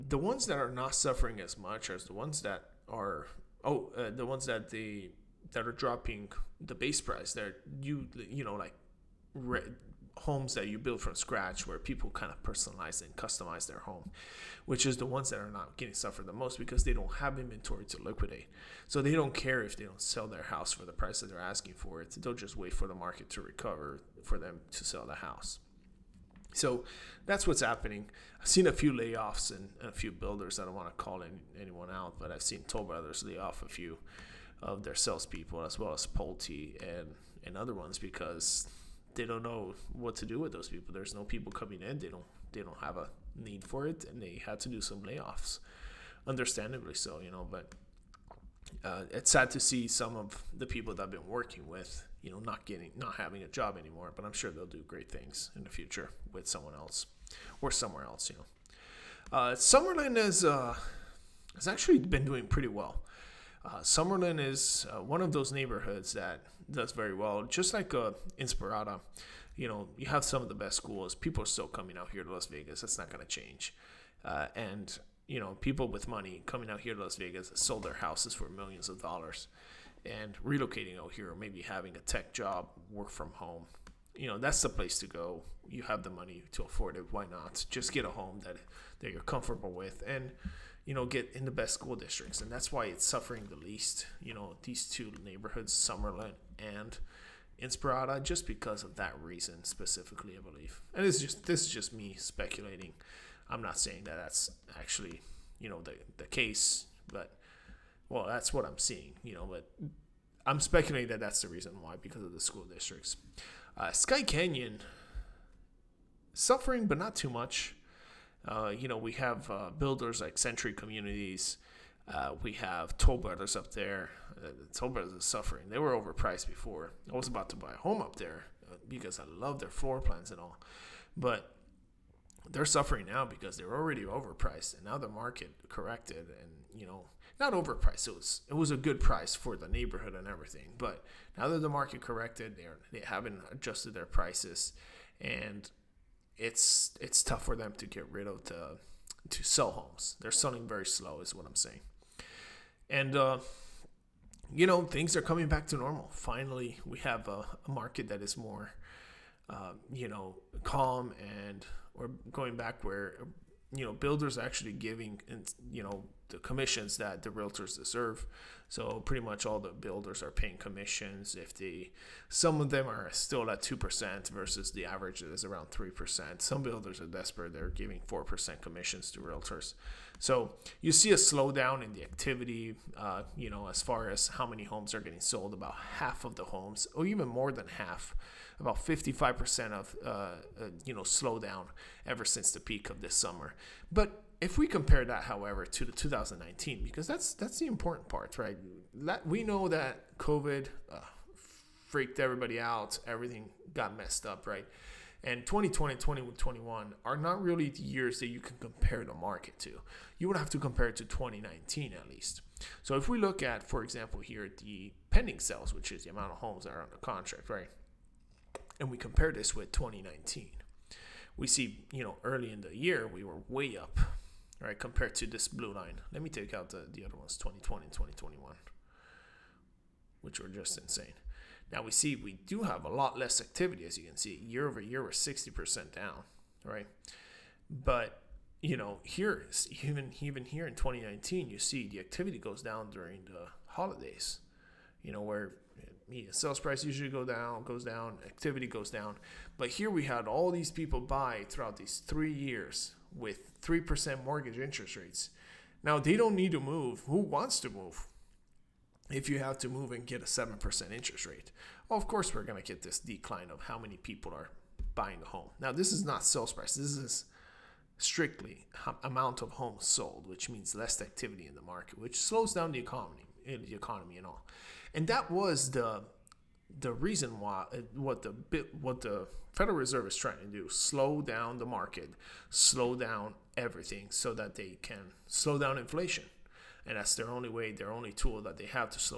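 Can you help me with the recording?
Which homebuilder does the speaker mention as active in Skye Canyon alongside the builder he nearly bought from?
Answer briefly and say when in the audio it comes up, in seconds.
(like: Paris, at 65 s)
Century Communities, at 120 s.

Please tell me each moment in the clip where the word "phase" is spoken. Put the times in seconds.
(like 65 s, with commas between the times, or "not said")
not said.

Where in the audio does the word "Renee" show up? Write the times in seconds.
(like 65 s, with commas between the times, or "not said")
not said.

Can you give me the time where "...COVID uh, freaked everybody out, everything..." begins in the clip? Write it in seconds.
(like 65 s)
200 s.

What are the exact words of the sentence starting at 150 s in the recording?
They're selling very slow, is what I'm saying.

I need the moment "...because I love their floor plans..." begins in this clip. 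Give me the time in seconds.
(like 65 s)
128 s.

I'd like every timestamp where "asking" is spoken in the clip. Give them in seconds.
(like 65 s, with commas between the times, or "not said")
21 s.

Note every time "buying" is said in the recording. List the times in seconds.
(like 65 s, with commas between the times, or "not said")
264 s.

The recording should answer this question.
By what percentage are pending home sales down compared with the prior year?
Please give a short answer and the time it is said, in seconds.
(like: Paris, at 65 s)
60%, at 235 s.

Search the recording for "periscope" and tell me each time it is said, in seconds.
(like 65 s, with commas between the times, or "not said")
not said.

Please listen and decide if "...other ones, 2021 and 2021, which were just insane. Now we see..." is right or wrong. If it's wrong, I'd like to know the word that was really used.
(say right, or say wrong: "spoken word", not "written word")
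wrong: "2020", not "2021".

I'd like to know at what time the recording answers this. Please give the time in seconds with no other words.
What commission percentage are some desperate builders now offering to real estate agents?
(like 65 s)
178 s.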